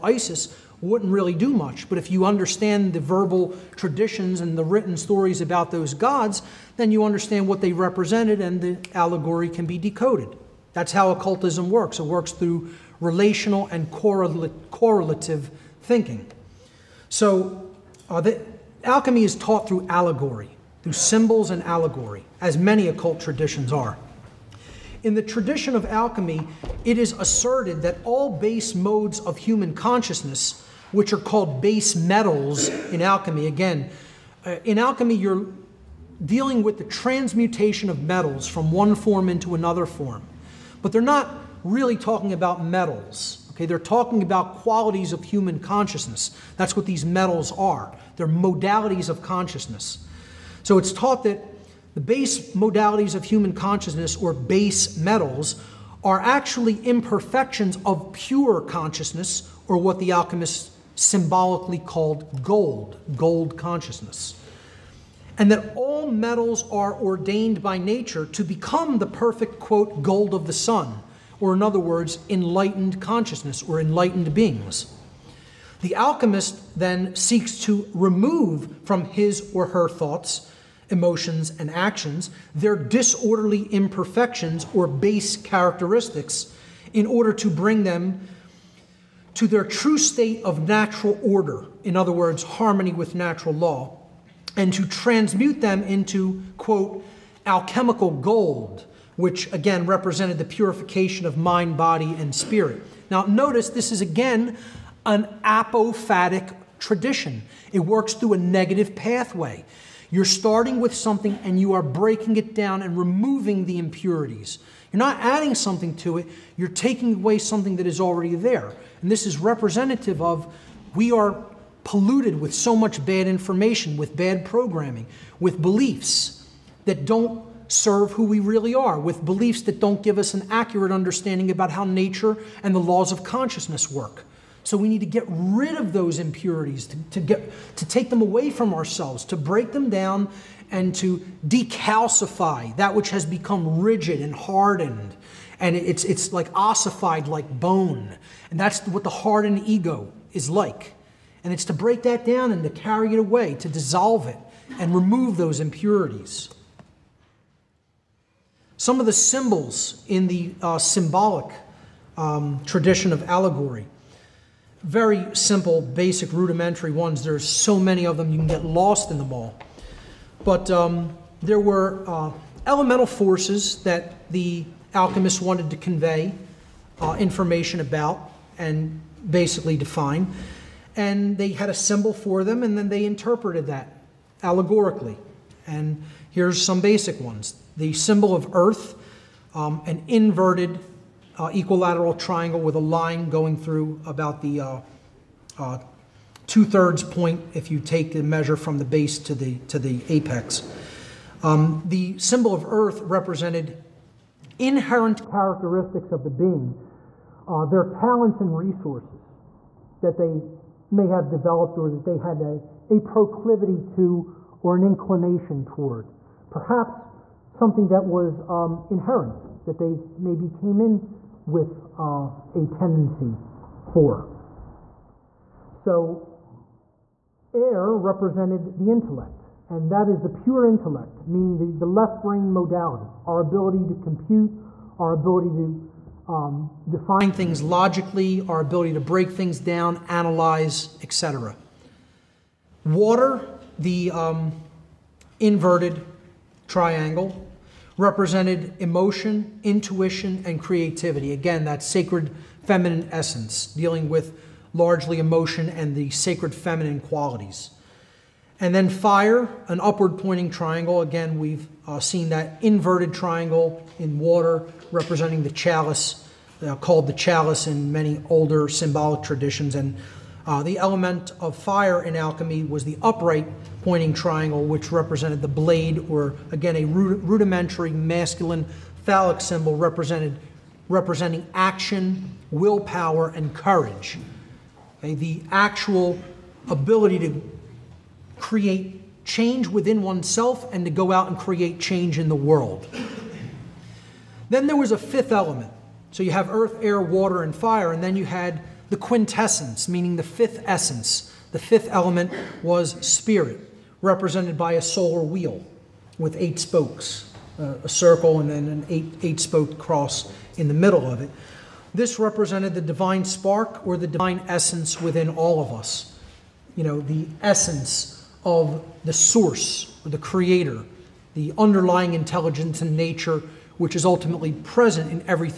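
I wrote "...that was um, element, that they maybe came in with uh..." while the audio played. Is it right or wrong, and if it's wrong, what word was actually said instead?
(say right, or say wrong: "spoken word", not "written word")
wrong: "inherent", not "element".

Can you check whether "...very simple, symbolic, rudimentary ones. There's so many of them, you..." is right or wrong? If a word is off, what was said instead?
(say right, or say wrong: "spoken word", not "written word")
wrong: "basic", not "symbolic".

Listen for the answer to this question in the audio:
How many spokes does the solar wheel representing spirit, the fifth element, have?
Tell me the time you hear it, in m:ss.
5:06.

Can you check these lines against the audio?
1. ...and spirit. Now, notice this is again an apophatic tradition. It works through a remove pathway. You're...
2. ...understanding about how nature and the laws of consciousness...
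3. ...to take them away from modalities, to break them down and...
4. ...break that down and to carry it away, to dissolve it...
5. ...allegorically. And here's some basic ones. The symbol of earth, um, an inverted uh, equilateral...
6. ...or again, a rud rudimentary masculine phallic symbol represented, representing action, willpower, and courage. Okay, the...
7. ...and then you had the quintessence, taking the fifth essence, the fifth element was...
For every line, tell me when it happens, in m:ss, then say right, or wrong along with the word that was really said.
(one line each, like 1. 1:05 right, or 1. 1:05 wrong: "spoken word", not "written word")
1. 1:42 wrong: "negative", not "remove"
2. 2:10 right
3. 2:17 wrong: "ourselves", not "modalities"
4. 2:31 right
5. 3:04 right
6. 4:36 right
7. 4:57 wrong: "meaning", not "taking".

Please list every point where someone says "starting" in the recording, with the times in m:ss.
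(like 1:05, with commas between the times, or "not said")
1:50.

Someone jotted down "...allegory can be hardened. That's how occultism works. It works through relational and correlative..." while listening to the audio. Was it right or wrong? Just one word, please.
wrong.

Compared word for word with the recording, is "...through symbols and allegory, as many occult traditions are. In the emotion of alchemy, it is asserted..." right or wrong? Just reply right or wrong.
wrong.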